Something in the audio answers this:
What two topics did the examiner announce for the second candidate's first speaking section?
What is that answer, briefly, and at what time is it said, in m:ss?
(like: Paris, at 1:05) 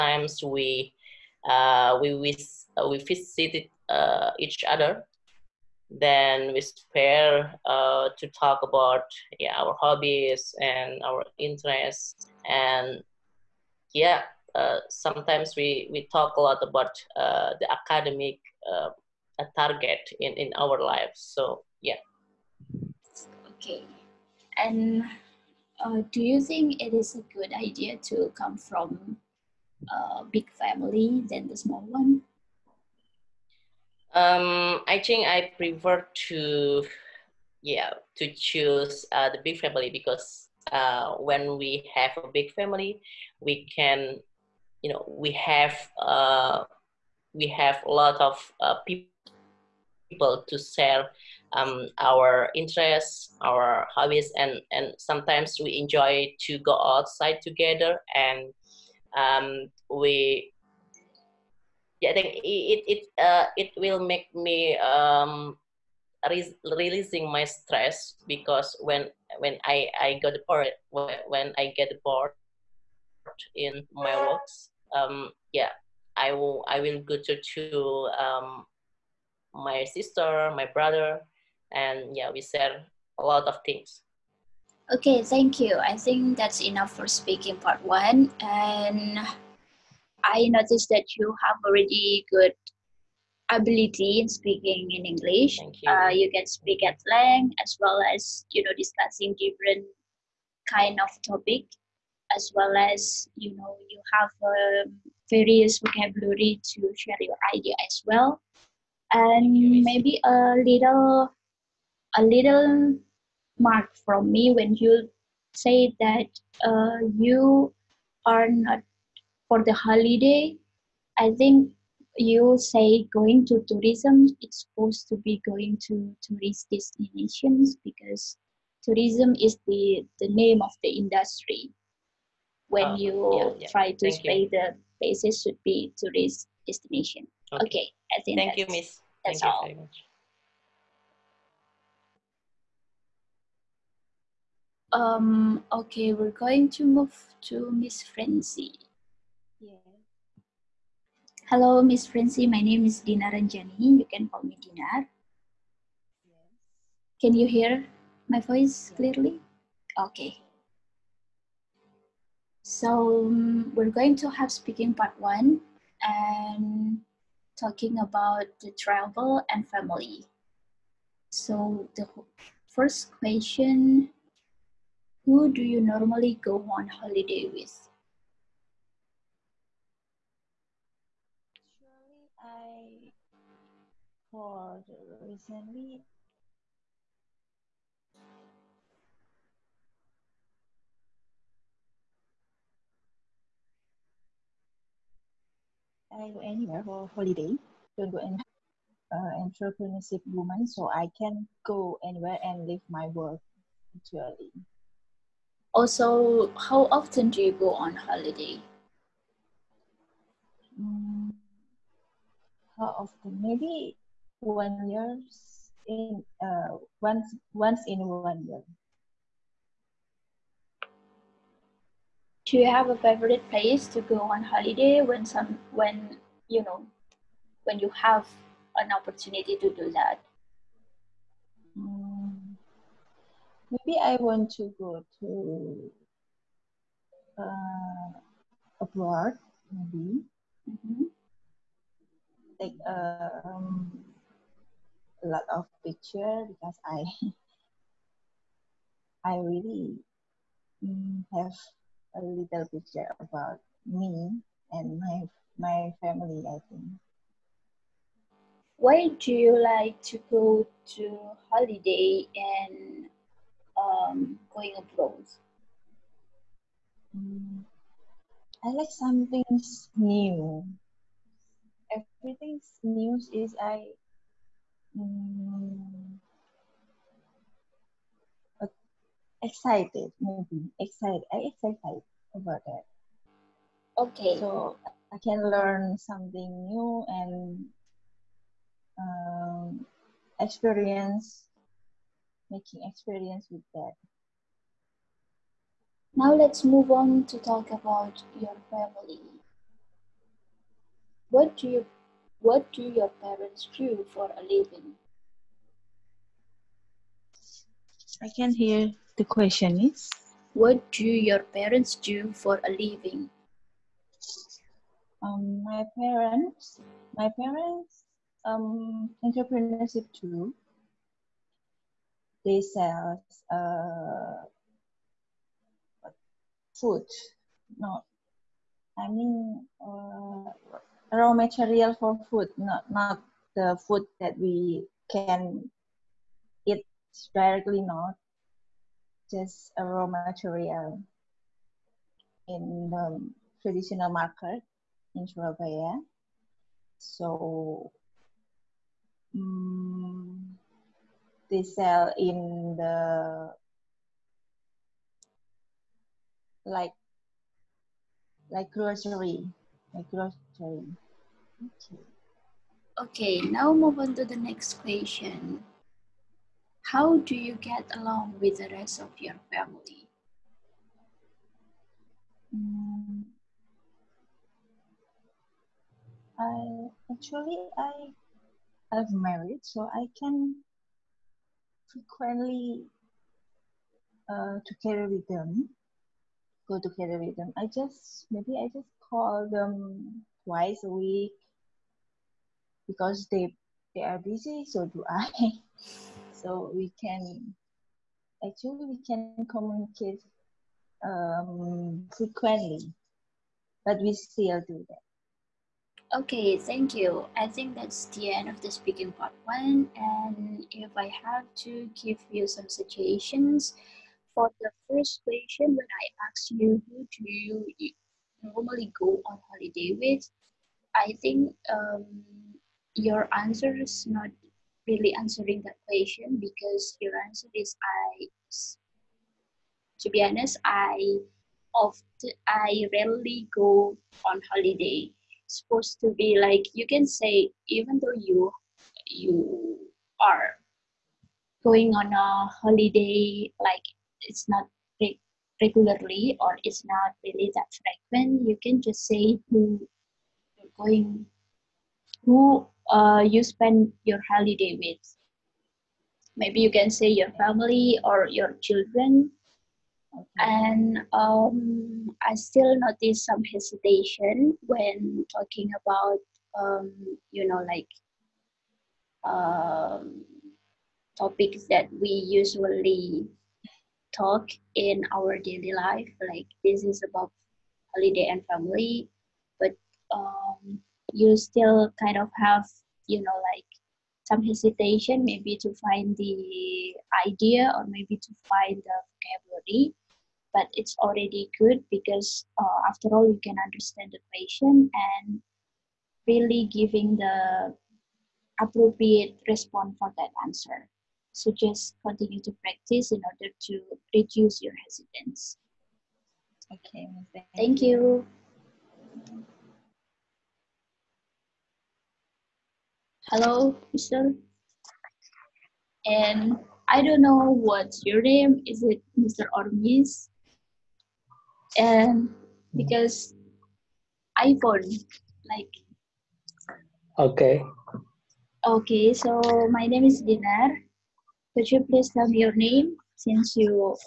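travel and family, at 2:48.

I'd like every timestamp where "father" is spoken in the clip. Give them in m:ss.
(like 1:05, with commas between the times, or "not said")
not said.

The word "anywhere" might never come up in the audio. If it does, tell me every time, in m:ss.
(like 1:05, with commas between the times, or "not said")
3:16, 3:22.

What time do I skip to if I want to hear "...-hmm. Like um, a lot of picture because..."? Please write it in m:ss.
4:00.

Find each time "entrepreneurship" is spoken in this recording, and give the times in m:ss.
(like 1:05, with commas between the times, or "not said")
3:19, 5:19.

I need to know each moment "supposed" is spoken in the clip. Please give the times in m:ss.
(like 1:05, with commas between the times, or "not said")
2:04, 7:15.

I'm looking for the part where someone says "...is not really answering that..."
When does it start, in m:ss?
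7:03.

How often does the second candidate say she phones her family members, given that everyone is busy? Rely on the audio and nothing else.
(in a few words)
twice a week.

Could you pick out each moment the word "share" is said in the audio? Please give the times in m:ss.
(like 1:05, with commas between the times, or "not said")
0:50, 1:22, 1:46.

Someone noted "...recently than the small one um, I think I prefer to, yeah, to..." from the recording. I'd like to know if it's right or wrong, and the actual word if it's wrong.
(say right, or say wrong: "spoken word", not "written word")
wrong: "family", not "recently".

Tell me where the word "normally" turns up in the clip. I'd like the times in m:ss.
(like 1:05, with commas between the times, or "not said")
2:55, 6:58.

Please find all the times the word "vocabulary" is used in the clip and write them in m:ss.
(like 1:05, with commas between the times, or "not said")
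1:45, 8:09.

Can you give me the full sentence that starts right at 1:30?
I noticed that you have already good ability in speaking in English.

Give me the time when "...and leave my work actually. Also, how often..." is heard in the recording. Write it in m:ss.
3:22.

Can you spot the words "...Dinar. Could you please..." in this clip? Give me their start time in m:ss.
8:50.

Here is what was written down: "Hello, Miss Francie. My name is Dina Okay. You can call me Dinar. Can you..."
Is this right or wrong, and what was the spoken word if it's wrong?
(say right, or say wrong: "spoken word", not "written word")
wrong: "Ranjani", not "Okay".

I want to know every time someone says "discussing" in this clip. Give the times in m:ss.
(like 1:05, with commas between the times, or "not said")
1:38.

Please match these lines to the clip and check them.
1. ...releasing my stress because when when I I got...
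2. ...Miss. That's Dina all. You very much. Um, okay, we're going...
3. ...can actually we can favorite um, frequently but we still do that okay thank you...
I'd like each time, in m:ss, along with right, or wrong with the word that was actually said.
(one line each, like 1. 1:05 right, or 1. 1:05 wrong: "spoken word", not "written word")
1. 1:06 right
2. 2:18 wrong: "Thank", not "Dina"
3. 6:37 wrong: "communicate", not "favorite".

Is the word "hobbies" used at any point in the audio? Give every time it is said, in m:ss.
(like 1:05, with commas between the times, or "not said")
0:09, 0:53.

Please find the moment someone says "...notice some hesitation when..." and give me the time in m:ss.
7:42.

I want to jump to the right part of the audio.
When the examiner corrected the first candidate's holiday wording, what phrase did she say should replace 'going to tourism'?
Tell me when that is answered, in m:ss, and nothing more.
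2:06.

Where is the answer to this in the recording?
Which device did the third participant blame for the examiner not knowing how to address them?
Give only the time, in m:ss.
8:44.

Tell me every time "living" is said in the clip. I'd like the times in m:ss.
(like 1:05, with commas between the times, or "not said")
5:04, 5:12.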